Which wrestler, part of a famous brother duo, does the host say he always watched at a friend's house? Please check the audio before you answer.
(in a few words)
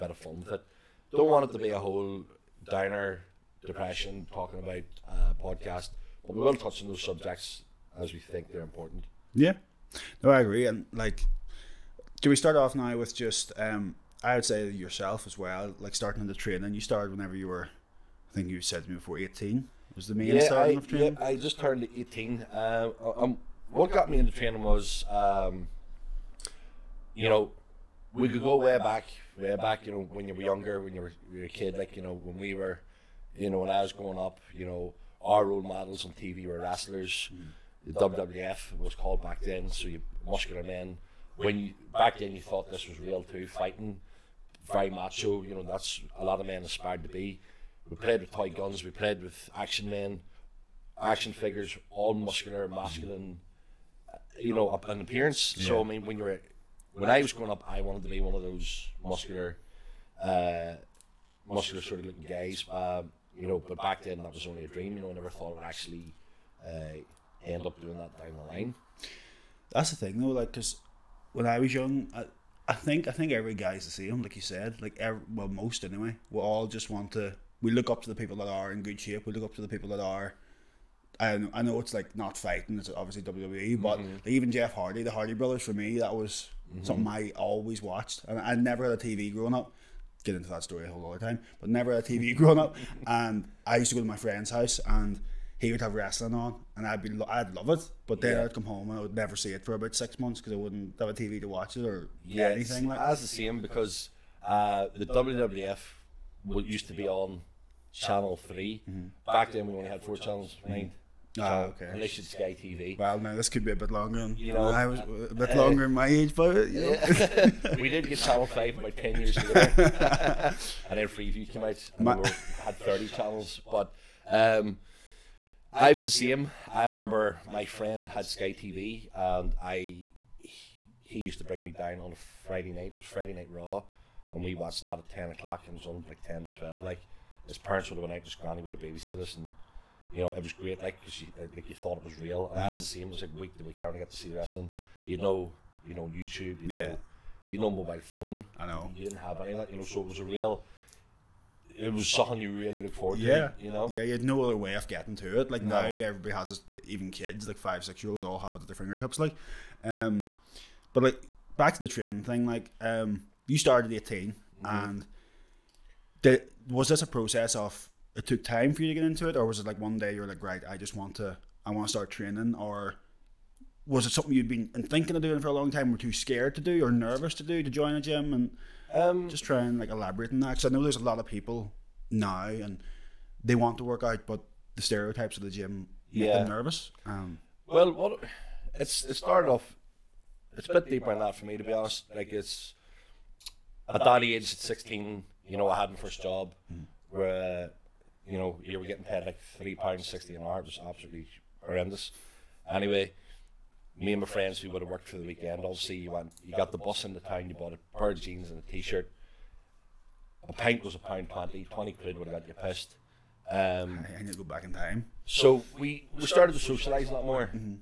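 Jeff Hardy.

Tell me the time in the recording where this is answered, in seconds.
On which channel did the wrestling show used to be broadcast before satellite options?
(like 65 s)
107 s.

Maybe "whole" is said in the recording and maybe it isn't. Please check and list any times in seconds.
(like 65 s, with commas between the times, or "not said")
1 s, 90 s.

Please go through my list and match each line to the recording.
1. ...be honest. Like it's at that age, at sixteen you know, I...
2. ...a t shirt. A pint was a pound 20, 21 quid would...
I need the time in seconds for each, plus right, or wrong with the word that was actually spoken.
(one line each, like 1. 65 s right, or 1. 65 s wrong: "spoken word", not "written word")
1. 191 s right
2. 208 s wrong: "20", not "21".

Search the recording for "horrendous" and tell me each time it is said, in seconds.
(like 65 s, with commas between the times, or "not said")
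201 s.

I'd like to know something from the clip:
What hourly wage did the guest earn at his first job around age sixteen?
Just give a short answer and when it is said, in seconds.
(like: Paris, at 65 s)
£3.60, at 199 s.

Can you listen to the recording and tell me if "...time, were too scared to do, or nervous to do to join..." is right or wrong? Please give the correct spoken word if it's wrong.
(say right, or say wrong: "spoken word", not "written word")
right.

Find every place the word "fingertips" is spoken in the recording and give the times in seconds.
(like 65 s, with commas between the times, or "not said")
158 s.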